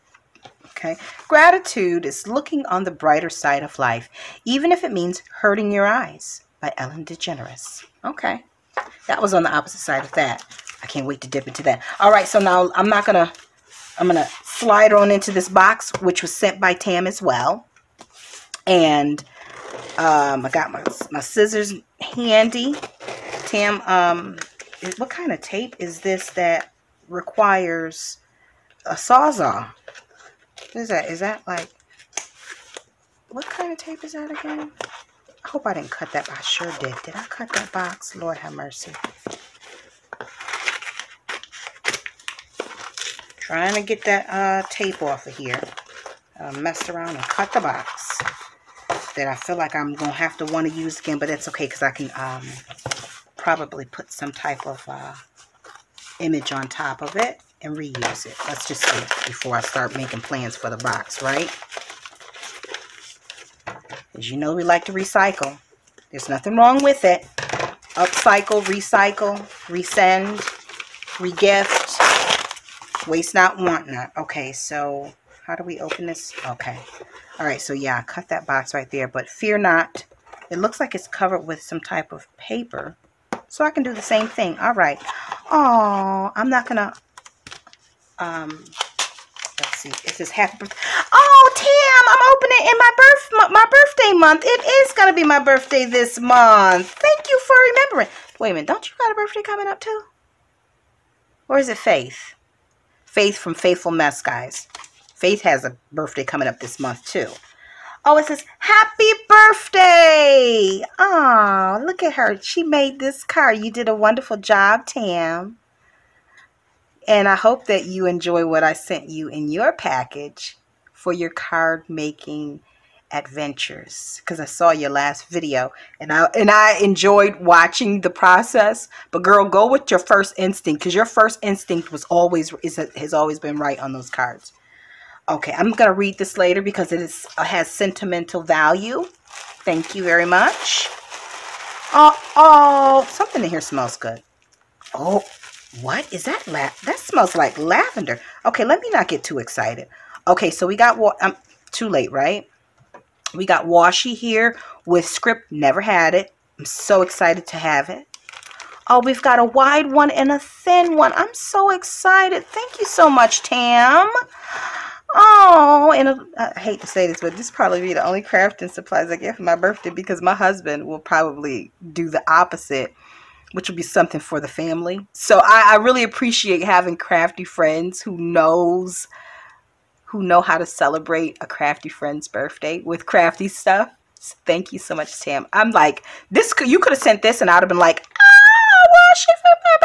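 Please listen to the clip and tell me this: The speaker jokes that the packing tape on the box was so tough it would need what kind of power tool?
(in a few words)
Sawzall.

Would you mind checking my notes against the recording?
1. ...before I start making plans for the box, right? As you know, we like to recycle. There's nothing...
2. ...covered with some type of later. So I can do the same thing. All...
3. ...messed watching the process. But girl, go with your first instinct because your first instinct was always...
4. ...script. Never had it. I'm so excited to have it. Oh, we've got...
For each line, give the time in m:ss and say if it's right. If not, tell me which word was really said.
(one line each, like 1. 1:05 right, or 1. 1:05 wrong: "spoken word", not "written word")
1. 0:59 right
2. 1:21 wrong: "paper", not "later"
3. 2:06 wrong: "enjoyed", not "messed"
4. 2:35 right.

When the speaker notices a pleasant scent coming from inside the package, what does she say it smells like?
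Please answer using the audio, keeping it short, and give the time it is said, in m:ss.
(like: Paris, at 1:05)
lavender, at 2:27.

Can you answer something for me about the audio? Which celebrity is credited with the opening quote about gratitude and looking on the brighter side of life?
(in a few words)
Ellen DeGeneres.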